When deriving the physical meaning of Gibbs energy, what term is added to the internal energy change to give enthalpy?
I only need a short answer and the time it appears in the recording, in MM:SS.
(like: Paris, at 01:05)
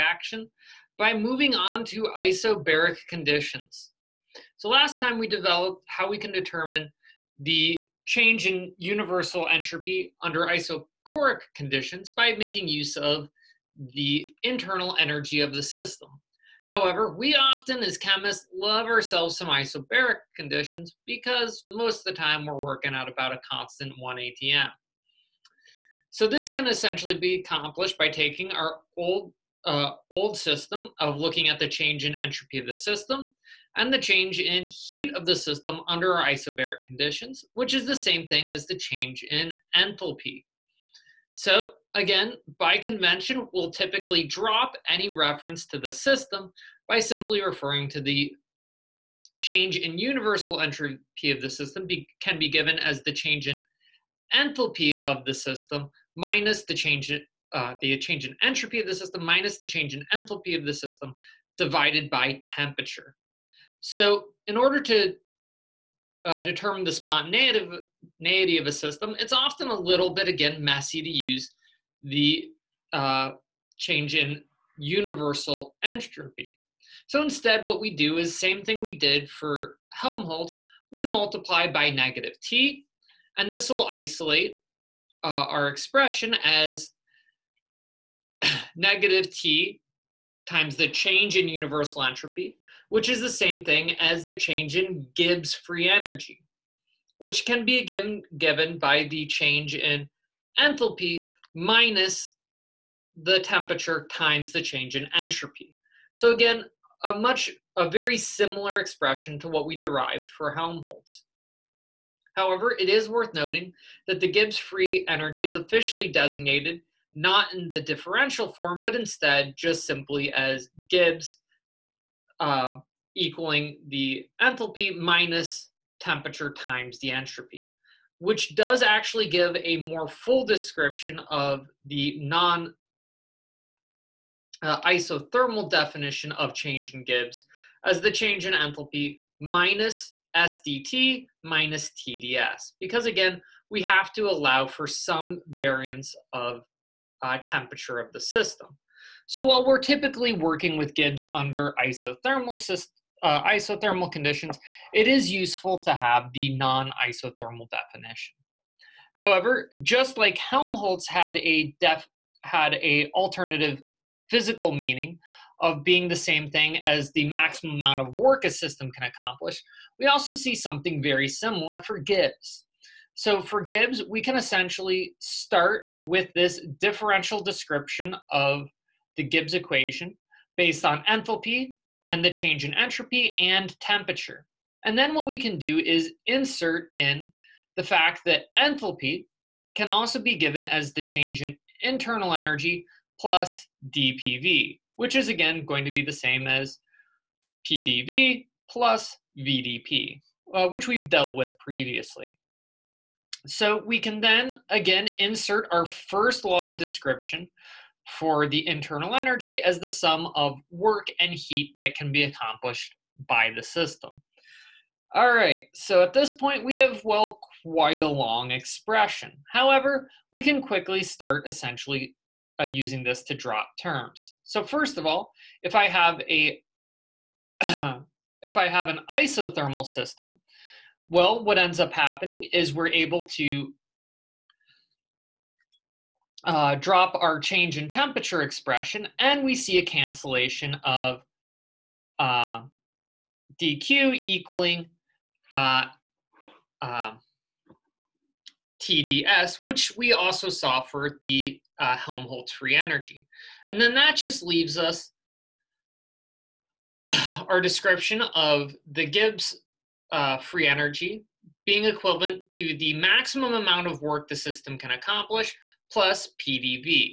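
dPV, at 03:13.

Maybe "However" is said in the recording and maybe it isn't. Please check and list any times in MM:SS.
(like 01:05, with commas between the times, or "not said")
00:16, 01:52, 02:39, 03:39.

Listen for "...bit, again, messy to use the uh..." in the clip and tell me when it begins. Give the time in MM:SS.
01:10.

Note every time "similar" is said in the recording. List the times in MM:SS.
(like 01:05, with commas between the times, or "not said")
01:48, 02:51.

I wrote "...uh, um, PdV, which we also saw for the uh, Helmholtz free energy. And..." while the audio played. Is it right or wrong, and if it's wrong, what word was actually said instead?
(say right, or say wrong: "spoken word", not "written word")
wrong: "TDS", not "PdV".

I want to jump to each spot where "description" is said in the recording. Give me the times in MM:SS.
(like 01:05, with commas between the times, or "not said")
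02:10, 02:57, 03:26, 04:17.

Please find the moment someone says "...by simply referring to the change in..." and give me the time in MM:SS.
00:46.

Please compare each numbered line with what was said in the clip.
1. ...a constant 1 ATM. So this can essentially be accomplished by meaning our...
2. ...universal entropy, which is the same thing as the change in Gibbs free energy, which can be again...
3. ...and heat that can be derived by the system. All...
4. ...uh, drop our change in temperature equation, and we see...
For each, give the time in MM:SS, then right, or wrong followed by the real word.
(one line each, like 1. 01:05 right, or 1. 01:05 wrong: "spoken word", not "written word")
1. 00:23 wrong: "taking", not "meaning"
2. 01:31 right
3. 03:31 wrong: "accomplished", not "derived"
4. 03:56 wrong: "expression", not "equation".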